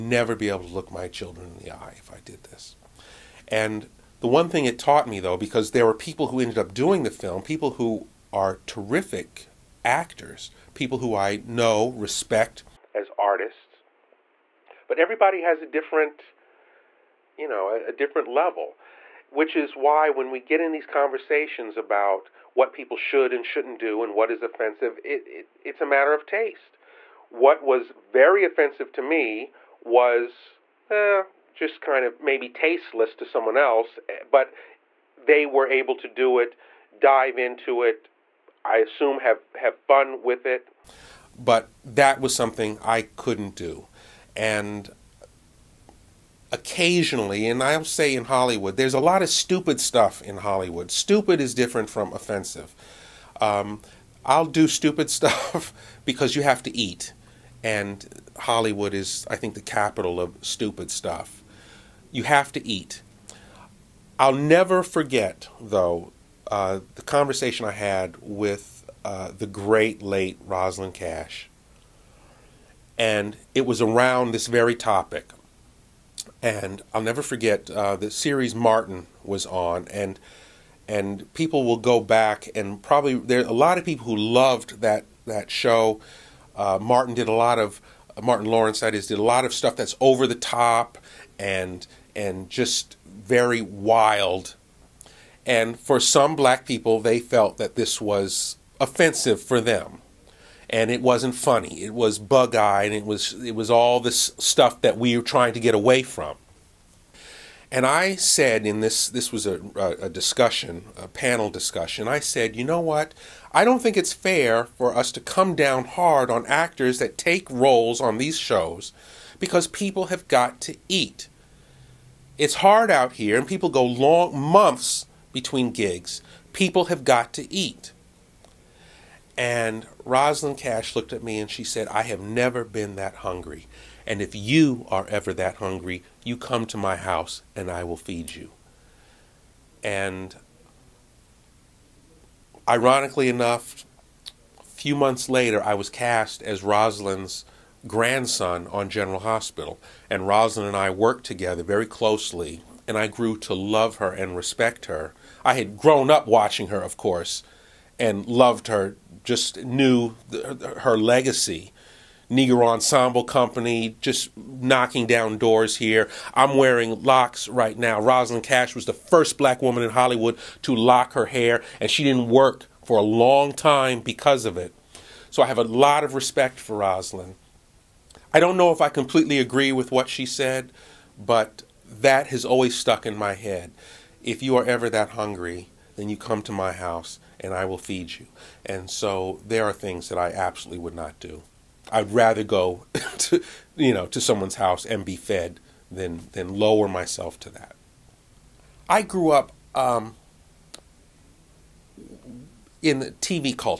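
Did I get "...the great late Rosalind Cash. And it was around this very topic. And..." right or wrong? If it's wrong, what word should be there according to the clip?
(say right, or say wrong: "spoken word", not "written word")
right.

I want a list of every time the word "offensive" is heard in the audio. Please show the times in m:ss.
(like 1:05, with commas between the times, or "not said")
0:24, 0:28, 0:52, 1:38.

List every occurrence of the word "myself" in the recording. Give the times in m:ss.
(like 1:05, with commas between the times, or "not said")
3:16.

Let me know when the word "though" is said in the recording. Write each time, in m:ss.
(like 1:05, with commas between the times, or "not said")
0:05, 1:05.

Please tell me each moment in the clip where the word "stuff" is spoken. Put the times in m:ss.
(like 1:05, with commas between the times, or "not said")
0:49, 0:55, 1:00, 1:29, 1:44.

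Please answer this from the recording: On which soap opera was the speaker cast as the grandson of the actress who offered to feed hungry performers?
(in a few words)
General Hospital.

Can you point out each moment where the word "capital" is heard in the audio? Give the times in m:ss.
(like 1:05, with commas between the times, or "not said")
0:59.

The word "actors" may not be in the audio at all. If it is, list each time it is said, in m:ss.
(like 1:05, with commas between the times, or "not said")
0:09, 1:56.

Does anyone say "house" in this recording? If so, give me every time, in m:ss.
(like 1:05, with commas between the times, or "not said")
2:16, 3:06, 3:14.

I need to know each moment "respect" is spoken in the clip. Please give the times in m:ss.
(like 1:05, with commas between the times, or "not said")
0:11, 2:34, 2:56.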